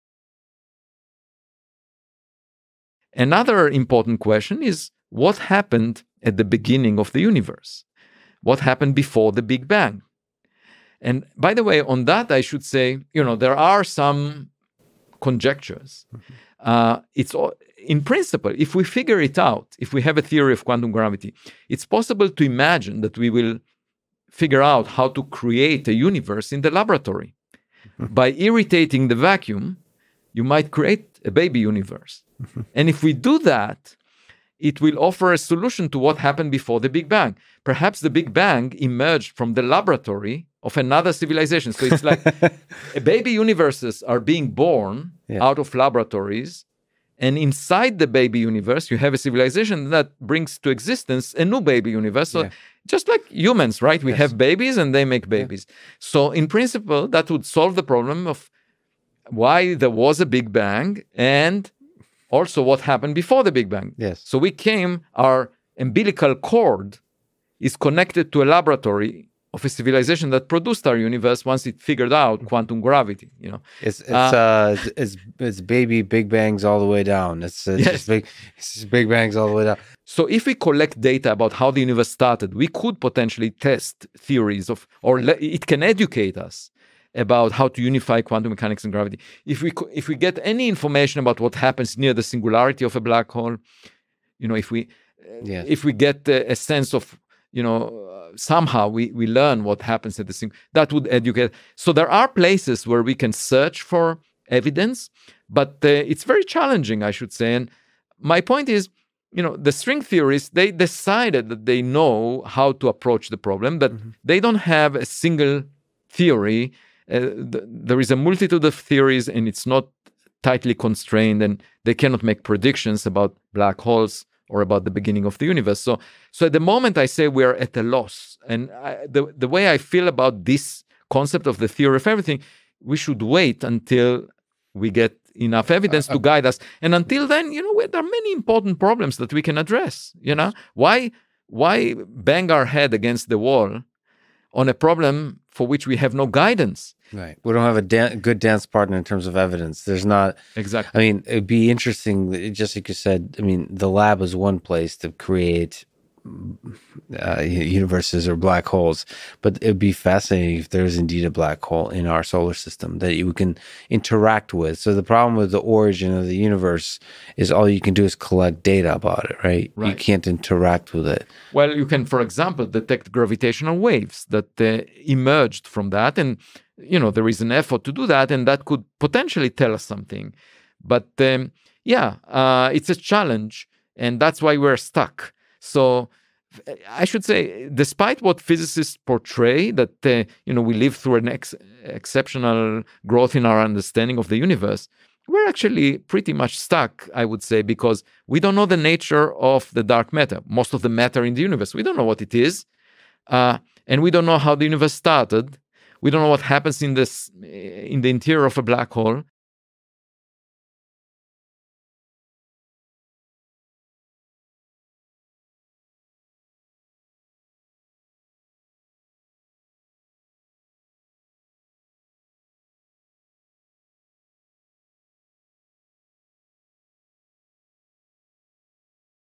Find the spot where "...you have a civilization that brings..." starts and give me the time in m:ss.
0:48.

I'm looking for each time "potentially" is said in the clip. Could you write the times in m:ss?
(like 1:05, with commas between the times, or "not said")
1:23, 2:58.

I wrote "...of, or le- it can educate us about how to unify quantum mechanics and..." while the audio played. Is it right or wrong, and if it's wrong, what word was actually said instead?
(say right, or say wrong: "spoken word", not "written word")
right.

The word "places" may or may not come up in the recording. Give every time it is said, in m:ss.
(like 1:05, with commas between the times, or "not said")
1:42, 2:34.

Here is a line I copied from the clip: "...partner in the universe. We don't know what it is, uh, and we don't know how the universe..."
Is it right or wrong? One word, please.
wrong.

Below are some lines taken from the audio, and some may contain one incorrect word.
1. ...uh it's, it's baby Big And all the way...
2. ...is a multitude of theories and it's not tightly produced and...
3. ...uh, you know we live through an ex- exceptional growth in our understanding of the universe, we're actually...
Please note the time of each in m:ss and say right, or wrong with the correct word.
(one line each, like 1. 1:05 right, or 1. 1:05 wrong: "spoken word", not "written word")
1. 1:14 wrong: "Bangs", not "And"
2. 1:57 wrong: "constrained", not "produced"
3. 3:10 right.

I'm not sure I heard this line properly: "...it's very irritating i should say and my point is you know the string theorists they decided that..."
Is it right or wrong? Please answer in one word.
wrong.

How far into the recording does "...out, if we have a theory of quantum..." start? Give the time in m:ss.
0:19.